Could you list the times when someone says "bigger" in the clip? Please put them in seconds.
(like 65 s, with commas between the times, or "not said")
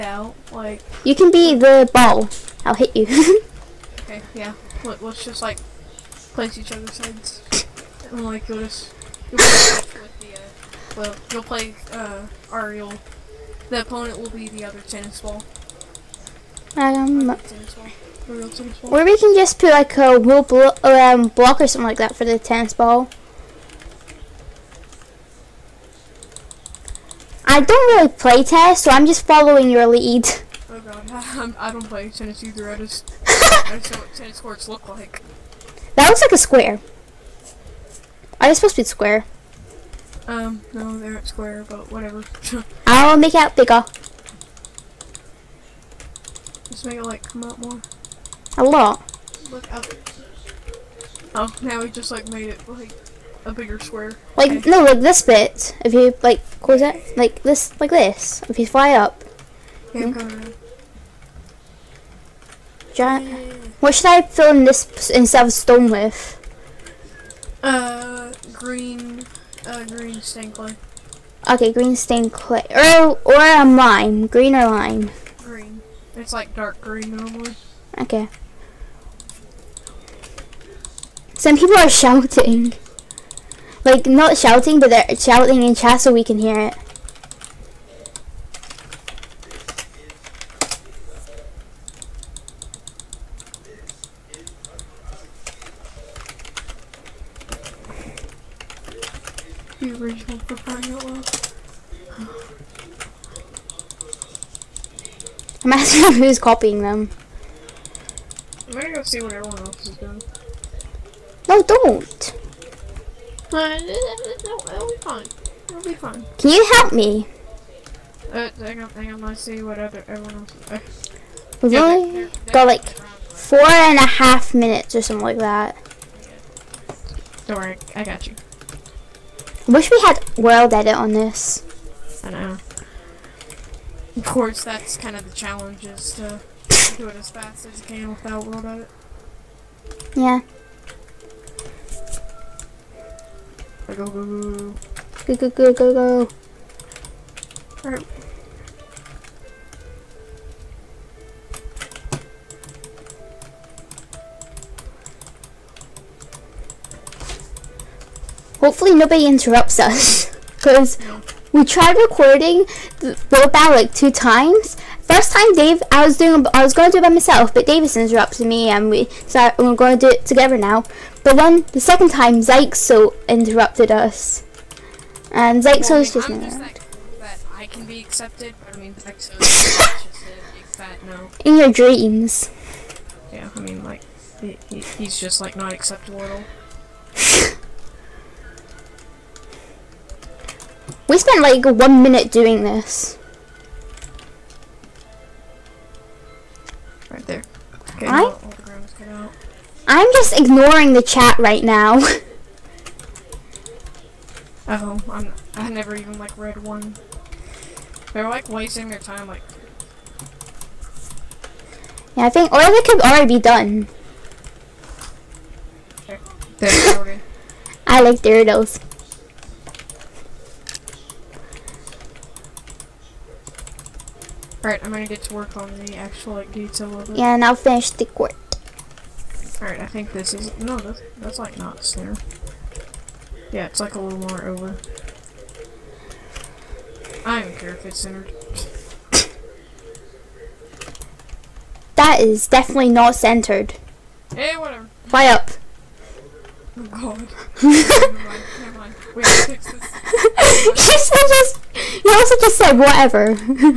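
43 s, 53 s.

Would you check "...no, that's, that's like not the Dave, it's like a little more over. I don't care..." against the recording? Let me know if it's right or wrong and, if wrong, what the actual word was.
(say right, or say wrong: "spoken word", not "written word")
wrong: "Yeah", not "Dave".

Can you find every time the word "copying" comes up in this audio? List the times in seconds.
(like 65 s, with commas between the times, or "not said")
106 s.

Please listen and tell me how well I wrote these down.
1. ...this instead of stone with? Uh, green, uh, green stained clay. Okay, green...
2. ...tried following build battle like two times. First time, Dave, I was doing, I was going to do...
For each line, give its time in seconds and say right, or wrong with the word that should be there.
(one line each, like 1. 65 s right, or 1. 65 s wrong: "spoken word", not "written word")
1. 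64 s right
2. 161 s wrong: "recording", not "following".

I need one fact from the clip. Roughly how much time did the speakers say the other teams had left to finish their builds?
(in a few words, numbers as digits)
4 and a half minutes.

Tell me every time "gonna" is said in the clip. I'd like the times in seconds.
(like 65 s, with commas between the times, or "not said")
108 s, 224 s.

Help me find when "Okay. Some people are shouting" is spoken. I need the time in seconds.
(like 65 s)
77 s.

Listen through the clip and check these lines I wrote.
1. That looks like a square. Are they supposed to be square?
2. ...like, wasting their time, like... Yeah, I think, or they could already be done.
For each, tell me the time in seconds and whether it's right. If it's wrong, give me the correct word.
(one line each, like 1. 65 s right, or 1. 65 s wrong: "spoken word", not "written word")
1. 35 s right
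2. 208 s right.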